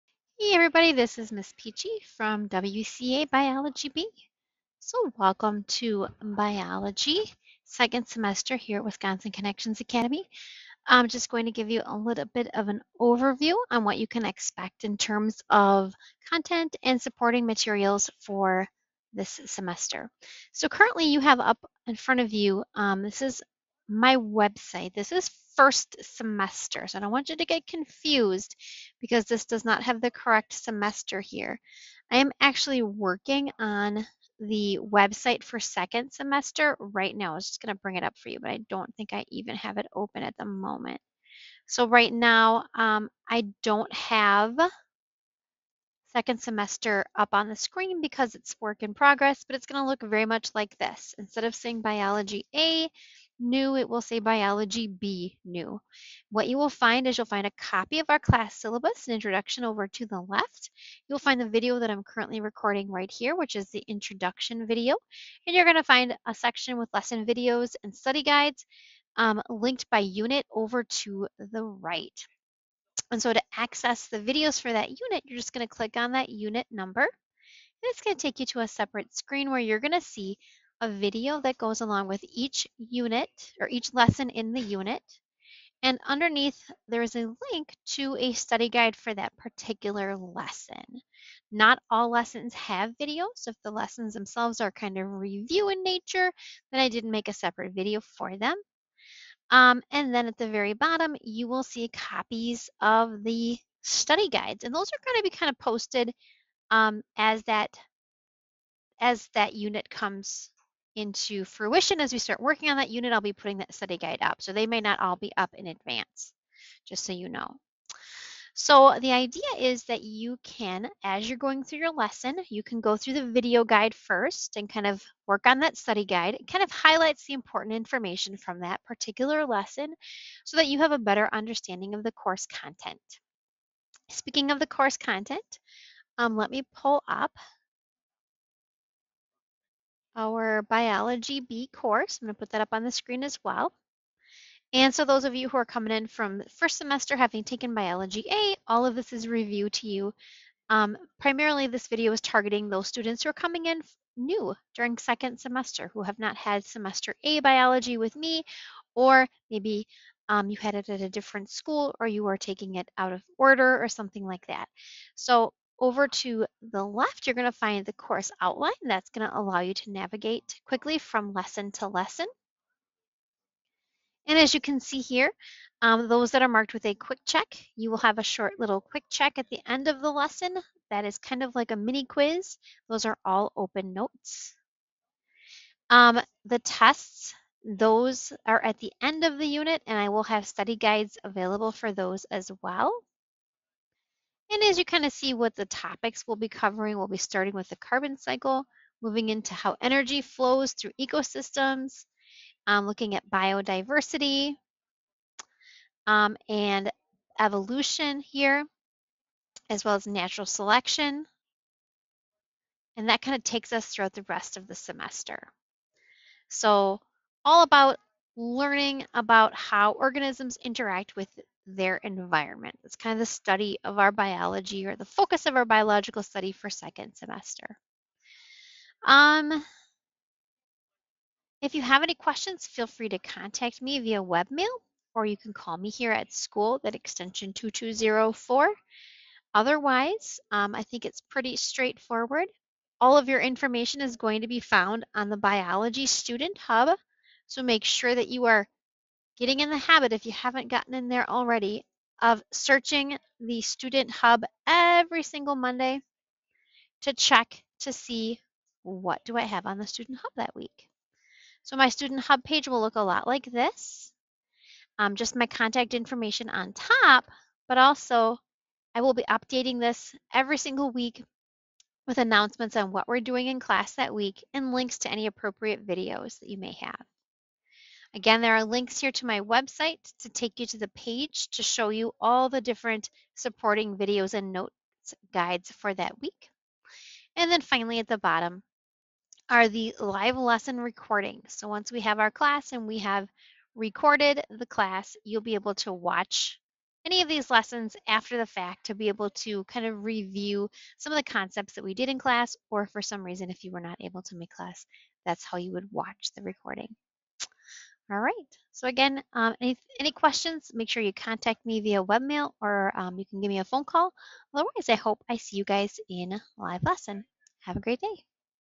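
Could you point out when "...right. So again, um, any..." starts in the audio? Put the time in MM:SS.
05:08.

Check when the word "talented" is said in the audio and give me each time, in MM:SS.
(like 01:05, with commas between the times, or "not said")
not said.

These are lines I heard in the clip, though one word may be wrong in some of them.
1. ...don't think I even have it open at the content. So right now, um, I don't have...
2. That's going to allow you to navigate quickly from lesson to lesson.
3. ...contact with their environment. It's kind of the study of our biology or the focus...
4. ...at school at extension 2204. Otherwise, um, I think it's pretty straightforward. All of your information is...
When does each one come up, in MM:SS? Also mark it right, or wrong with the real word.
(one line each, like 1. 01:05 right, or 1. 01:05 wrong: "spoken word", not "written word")
1. 00:38 wrong: "moment", not "content"
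2. 02:48 right
3. 03:40 wrong: "interact", not "contact"
4. 03:56 right.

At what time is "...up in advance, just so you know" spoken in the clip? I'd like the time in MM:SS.
01:55.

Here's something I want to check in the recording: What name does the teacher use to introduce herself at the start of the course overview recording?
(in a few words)
Miss Peachy.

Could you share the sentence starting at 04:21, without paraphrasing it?
So my Student Hub page will look a lot like this.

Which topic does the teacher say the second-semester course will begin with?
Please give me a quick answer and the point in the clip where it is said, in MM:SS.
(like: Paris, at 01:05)
carbon cycle, at 03:17.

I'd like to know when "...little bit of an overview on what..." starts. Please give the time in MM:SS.
00:11.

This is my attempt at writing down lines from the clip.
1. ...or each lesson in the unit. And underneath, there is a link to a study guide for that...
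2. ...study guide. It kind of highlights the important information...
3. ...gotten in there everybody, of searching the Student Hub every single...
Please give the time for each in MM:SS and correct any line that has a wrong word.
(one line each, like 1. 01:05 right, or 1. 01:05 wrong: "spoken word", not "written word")
1. 01:23 right
2. 02:05 right
3. 04:10 wrong: "already", not "everybody".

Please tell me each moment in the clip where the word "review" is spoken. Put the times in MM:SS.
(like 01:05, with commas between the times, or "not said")
01:35, 02:29, 05:00.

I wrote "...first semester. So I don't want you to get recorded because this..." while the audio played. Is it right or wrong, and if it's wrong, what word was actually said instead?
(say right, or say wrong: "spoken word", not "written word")
wrong: "confused", not "recorded".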